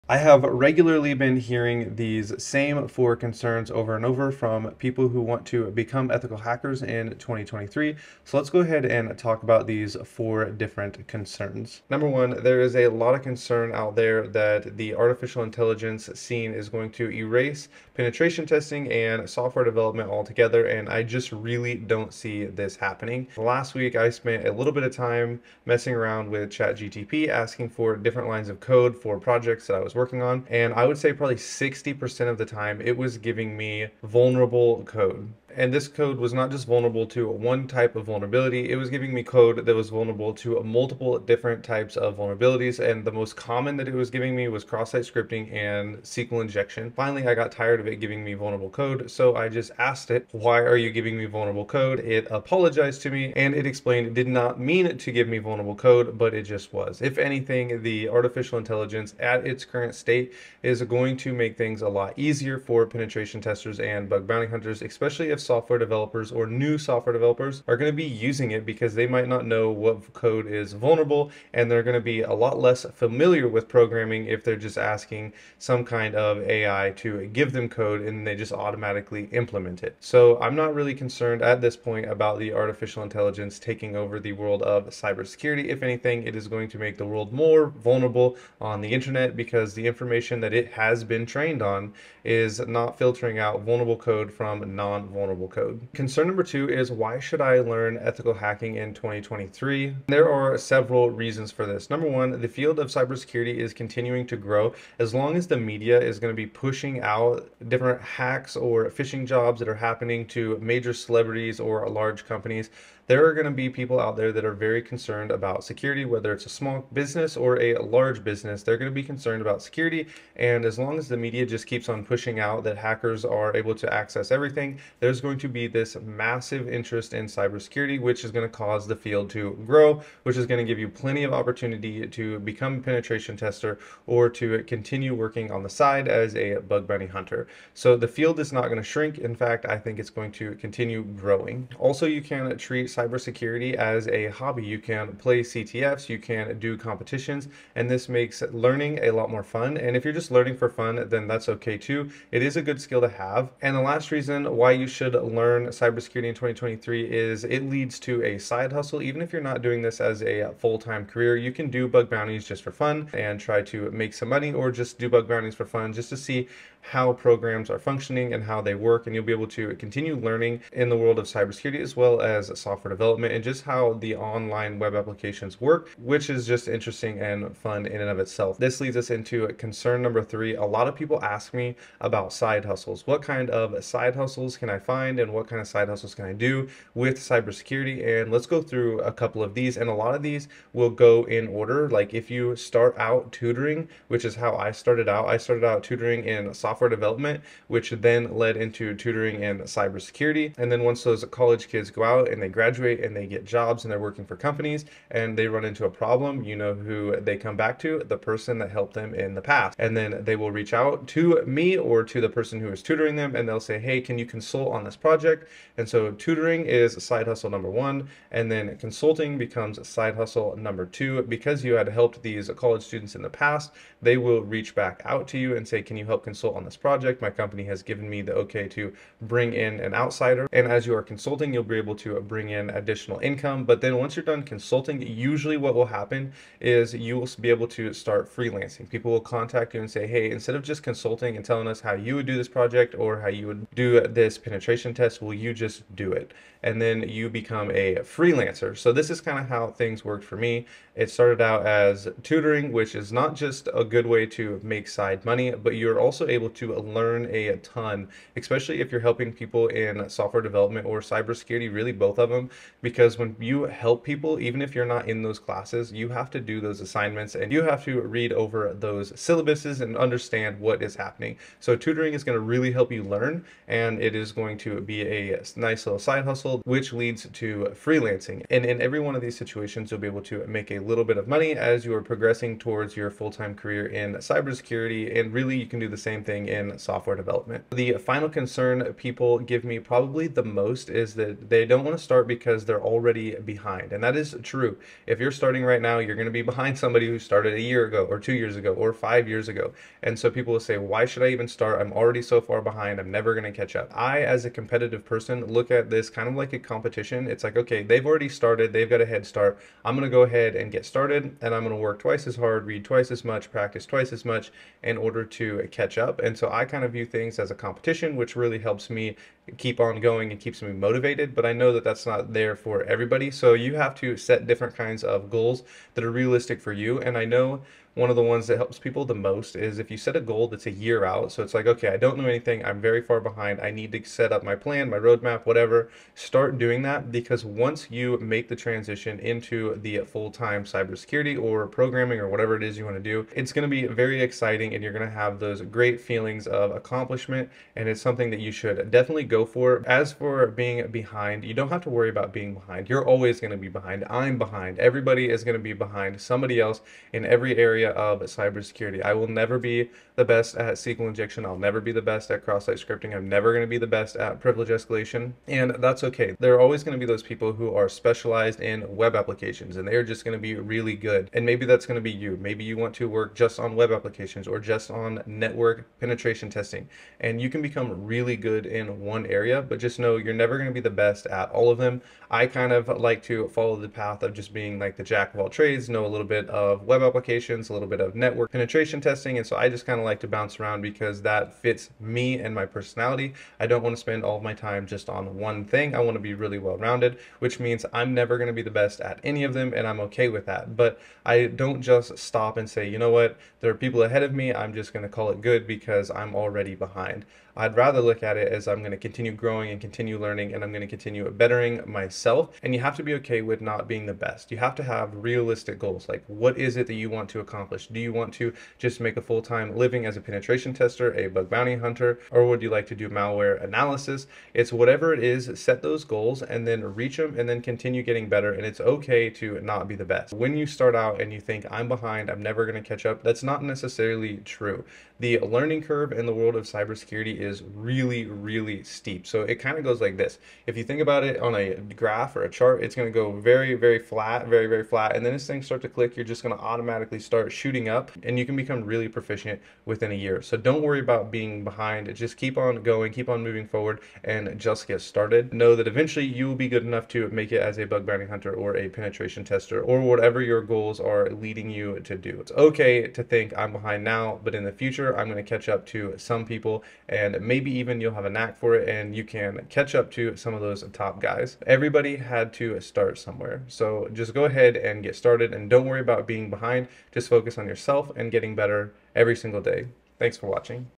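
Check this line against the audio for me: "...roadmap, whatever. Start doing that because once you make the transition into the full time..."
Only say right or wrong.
right.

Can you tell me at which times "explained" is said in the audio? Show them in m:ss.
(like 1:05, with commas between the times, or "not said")
0:53.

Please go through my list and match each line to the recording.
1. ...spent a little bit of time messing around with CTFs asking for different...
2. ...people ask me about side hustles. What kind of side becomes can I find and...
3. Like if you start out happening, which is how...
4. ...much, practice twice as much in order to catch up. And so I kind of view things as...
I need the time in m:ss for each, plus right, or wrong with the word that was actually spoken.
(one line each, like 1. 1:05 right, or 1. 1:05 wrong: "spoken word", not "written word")
1. 0:24 wrong: "ChatGTP", not "CTFs"
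2. 3:00 wrong: "hustles", not "becomes"
3. 3:11 wrong: "tutoring", not "happening"
4. 5:13 right.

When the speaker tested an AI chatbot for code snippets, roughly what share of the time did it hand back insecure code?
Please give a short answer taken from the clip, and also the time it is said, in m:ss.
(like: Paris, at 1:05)
60%, at 0:31.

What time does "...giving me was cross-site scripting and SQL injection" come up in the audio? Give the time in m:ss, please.
0:44.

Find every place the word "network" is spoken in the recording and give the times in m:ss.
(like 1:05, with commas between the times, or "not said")
6:15, 6:28.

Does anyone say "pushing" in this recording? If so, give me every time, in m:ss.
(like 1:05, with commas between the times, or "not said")
1:46, 2:02.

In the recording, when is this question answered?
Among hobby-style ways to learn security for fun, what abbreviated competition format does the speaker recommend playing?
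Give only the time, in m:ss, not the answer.
2:25.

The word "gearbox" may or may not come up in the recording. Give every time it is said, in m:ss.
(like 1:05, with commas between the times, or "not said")
not said.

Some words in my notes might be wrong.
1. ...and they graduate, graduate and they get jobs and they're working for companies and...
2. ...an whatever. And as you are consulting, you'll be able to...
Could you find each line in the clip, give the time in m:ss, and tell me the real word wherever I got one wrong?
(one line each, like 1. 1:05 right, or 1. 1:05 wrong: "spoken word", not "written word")
1. 3:22 right
2. 3:49 wrong: "outsider", not "whatever".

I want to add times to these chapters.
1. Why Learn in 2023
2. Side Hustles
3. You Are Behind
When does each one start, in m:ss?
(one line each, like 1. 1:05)
1. 1:35
2. 3:00
3. 4:47.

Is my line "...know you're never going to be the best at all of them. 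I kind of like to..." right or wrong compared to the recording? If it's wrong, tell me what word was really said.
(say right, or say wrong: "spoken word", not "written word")
right.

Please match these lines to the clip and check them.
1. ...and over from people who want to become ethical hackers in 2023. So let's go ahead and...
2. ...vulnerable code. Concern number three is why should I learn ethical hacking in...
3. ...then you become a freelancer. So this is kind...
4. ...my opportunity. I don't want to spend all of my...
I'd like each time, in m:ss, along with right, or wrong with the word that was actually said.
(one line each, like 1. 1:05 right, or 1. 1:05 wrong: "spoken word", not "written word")
1. 0:03 right
2. 1:35 wrong: "two", not "three"
3. 4:06 right
4. 6:32 wrong: "personality", not "opportunity".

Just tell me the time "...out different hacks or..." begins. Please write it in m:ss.
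1:47.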